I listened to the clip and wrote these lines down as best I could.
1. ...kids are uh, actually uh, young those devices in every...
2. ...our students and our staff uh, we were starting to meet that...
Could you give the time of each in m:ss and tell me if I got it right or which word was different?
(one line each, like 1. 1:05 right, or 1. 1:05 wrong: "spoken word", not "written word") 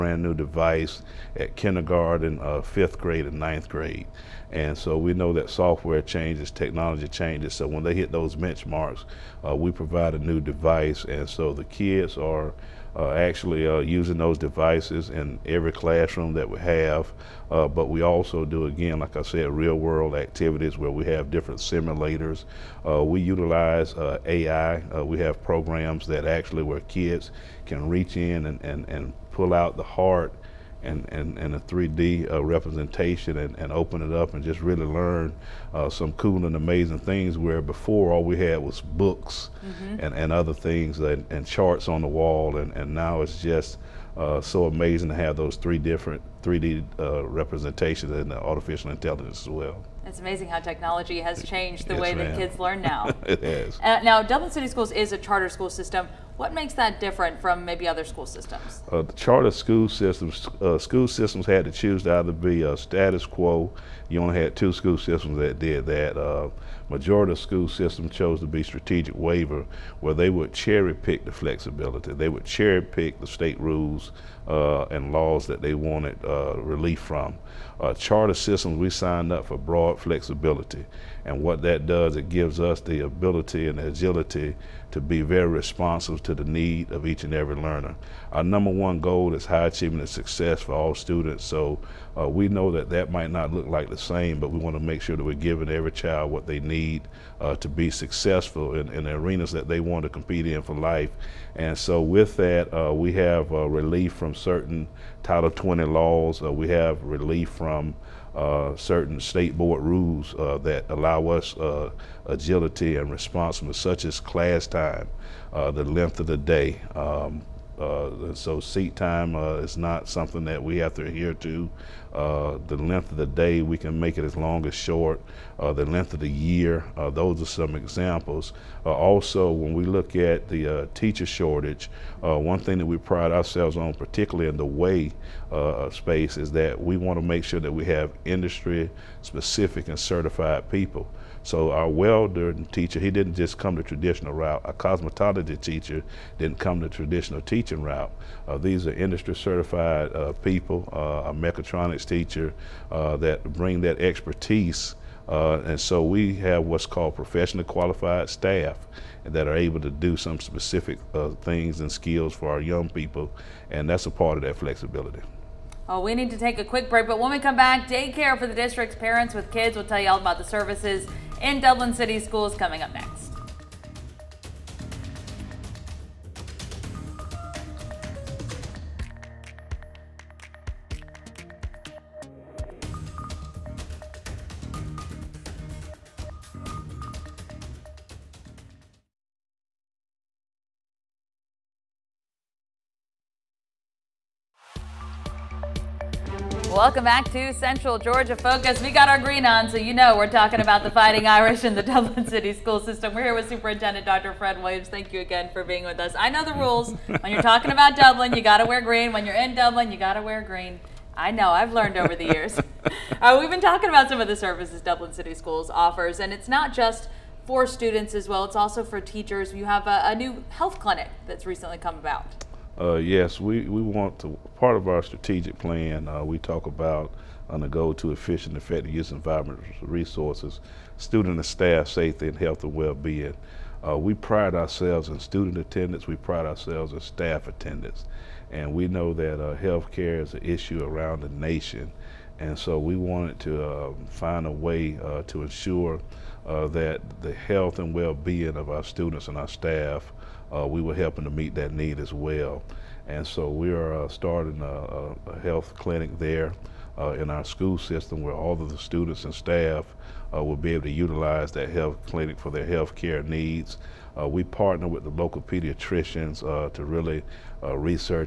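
1. 0:11 wrong: "using", not "young"
2. 4:08 wrong: "helping", not "starting".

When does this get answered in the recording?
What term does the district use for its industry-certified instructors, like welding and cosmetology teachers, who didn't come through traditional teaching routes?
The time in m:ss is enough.
2:37.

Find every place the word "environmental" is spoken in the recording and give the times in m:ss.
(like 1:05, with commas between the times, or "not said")
3:49.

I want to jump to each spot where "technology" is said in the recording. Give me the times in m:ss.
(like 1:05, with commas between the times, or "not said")
0:06, 0:50.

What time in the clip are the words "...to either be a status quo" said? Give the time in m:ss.
1:02.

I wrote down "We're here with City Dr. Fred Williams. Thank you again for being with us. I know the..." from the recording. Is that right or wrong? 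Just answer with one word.
wrong.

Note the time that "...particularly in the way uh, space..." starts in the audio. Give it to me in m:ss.
2:13.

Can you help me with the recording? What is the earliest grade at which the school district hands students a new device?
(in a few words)
Kindergarten.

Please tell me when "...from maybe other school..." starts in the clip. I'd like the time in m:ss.
0:57.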